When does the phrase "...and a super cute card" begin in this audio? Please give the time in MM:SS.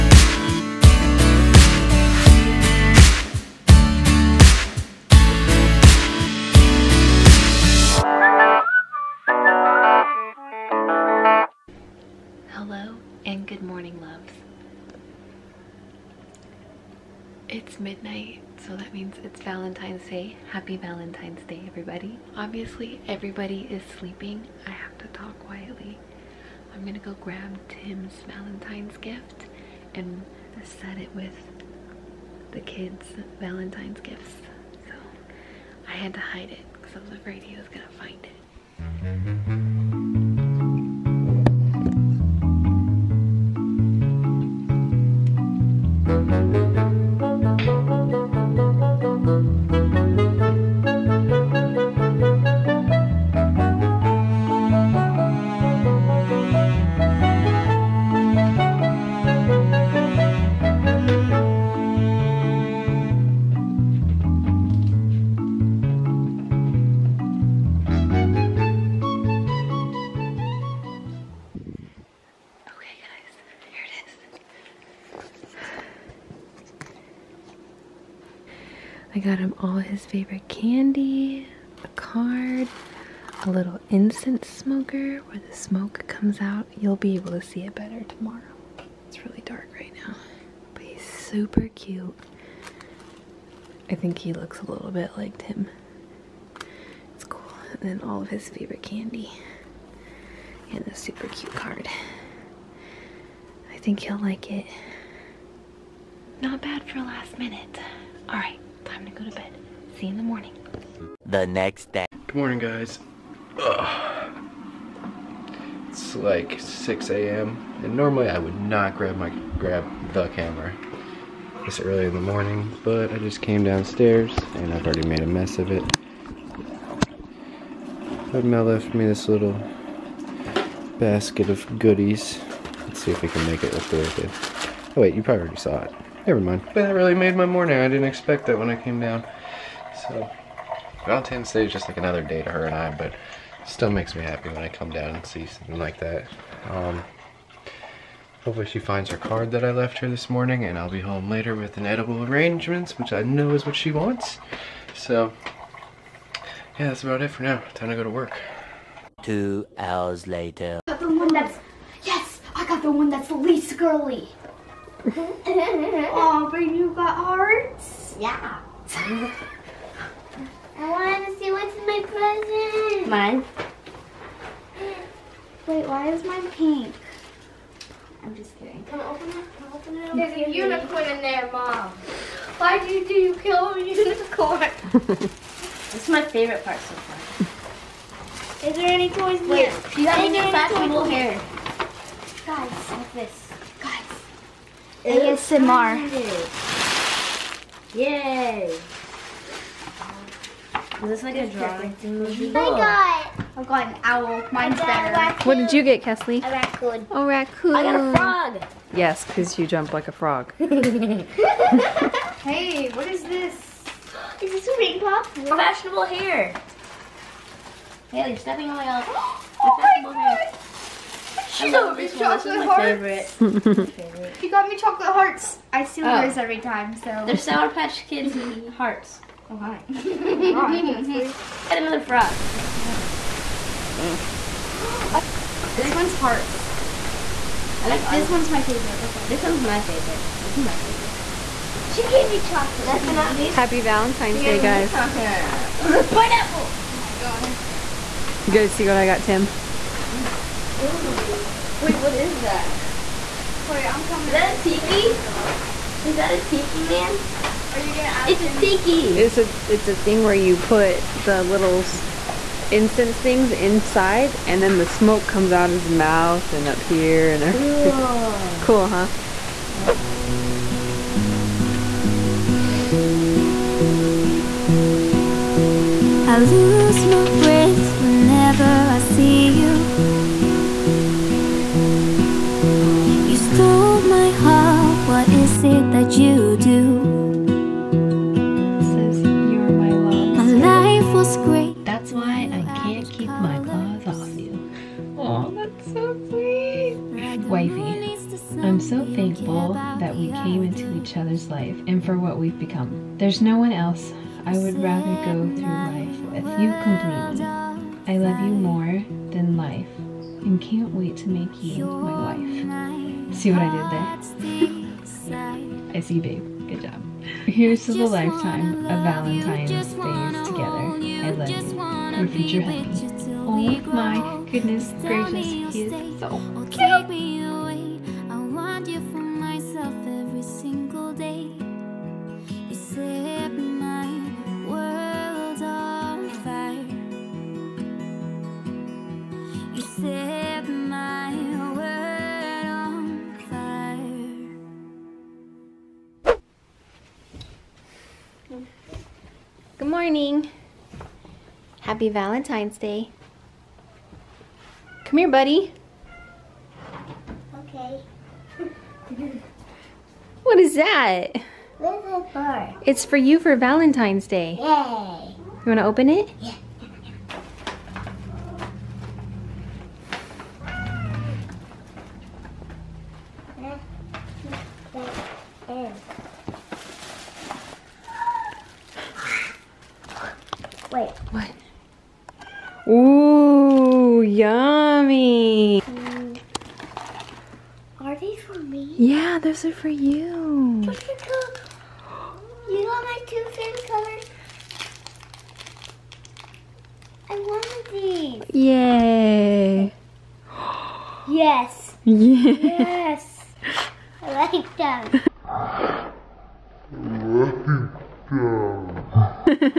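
01:40.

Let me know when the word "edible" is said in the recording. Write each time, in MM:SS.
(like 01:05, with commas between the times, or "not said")
02:31.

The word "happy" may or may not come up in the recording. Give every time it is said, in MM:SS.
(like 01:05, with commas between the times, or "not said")
00:20, 02:24, 04:03, 05:51.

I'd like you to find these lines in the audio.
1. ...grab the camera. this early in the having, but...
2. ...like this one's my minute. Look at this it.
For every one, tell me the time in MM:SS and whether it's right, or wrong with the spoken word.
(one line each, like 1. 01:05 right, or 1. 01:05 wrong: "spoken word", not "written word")
1. 01:59 wrong: "morning", not "having"
2. 03:57 wrong: "favorite", not "minute".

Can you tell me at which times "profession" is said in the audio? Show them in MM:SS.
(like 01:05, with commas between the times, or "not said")
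not said.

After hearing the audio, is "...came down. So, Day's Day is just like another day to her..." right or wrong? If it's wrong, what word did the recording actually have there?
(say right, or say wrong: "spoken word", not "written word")
wrong: "Valentine", not "Day".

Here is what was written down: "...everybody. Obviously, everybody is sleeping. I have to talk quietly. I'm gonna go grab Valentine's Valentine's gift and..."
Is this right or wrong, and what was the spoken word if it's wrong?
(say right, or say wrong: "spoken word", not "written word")
wrong: "Tim", not "Valentine".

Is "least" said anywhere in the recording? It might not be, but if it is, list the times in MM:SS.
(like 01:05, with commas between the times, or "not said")
02:43, 04:03.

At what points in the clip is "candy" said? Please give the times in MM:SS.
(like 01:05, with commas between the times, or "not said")
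01:20, 01:38.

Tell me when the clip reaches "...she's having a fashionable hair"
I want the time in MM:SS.
03:09.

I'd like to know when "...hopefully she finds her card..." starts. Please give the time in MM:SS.
02:28.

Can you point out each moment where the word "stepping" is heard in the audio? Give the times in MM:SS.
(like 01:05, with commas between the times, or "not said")
03:38.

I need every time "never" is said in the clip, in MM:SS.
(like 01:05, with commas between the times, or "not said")
02:16.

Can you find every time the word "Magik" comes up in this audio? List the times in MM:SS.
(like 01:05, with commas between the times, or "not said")
not said.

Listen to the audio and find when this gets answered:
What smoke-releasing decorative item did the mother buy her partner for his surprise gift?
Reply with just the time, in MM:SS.
01:23.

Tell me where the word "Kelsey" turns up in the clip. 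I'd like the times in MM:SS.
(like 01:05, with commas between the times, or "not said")
03:26.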